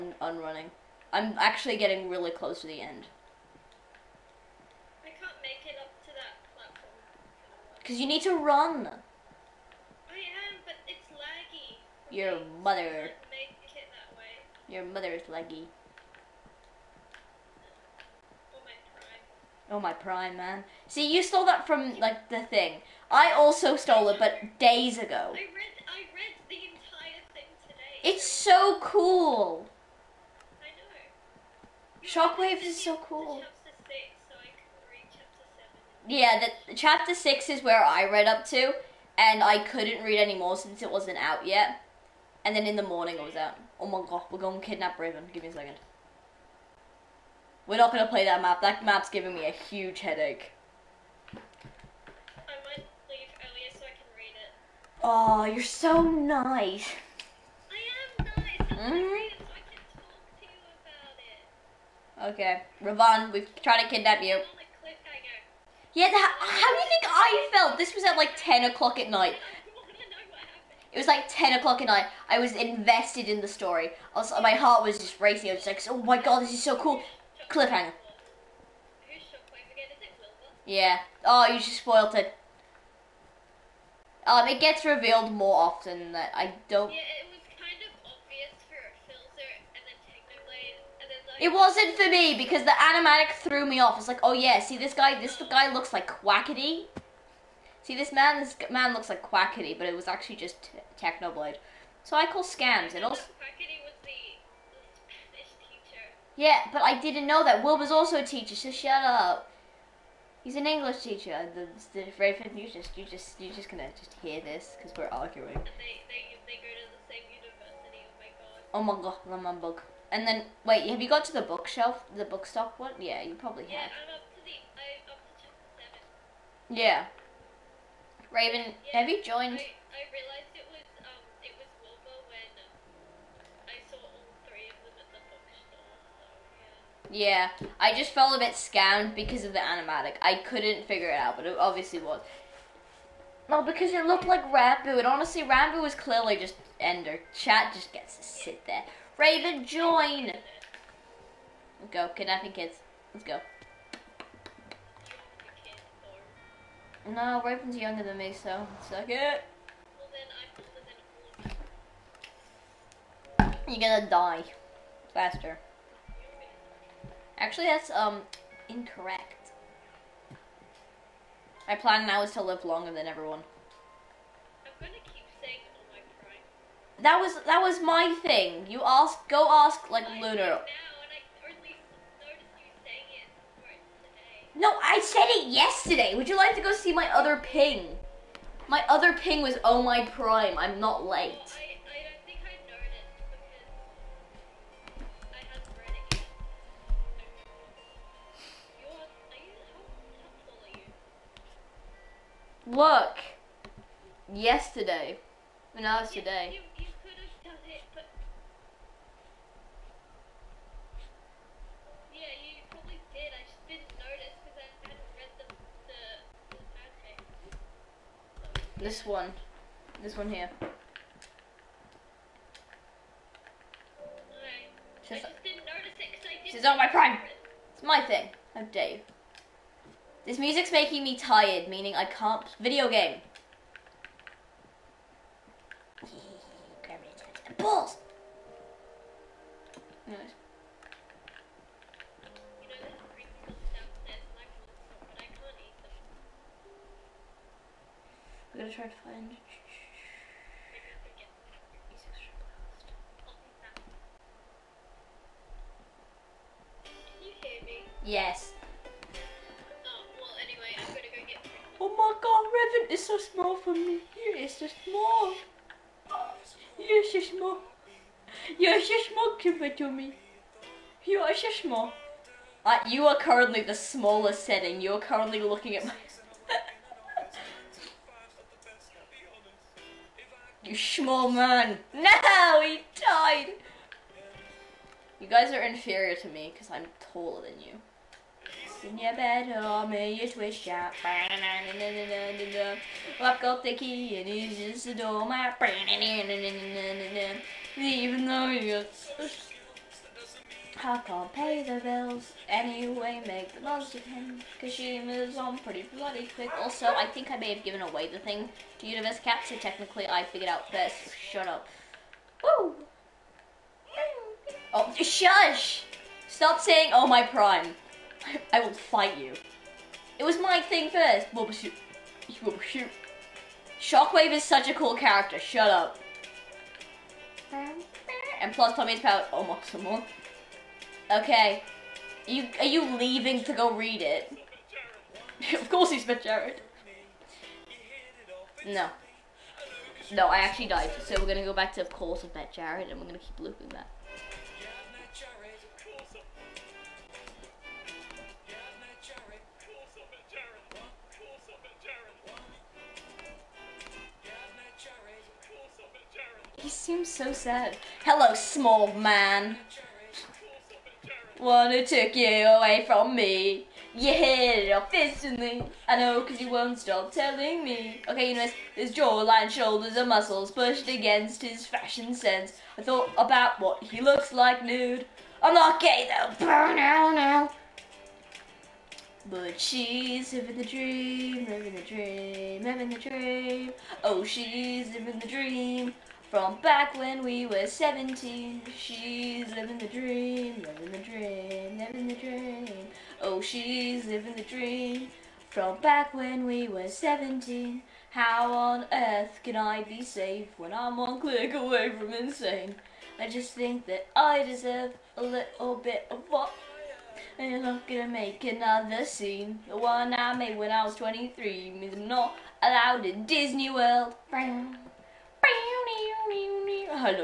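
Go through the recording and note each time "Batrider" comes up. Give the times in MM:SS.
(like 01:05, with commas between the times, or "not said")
not said.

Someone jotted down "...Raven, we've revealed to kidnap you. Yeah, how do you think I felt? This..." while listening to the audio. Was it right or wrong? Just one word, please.
wrong.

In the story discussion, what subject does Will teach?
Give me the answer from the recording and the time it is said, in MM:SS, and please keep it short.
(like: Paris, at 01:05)
English, at 01:50.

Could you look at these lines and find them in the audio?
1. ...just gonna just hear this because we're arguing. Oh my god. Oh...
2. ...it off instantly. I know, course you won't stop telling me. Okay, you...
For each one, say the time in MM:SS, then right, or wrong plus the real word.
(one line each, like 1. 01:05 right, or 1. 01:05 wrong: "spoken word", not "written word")
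1. 01:53 right
2. 06:04 wrong: "cause", not "course".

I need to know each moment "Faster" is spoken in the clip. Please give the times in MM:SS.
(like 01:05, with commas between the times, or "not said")
02:45.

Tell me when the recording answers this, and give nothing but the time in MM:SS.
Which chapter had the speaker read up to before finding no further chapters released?
00:36.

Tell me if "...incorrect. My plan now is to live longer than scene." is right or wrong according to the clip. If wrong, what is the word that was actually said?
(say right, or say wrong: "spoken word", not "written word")
wrong: "everyone", not "scene".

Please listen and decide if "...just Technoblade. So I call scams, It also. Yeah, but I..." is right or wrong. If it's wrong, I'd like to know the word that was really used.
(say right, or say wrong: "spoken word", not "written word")
right.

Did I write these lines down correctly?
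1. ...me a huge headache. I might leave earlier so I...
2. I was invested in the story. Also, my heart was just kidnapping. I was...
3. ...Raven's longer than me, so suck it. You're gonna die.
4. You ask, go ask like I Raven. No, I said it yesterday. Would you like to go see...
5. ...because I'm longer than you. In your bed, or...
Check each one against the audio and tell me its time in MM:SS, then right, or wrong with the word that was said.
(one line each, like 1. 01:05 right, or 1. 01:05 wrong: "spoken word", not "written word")
1. 00:49 right
2. 01:12 wrong: "racing", not "kidnapping"
3. 02:37 wrong: "younger", not "longer"
4. 02:58 wrong: "Lunar", not "Raven"
5. 04:46 wrong: "taller", not "longer".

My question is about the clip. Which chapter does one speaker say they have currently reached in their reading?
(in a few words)
7.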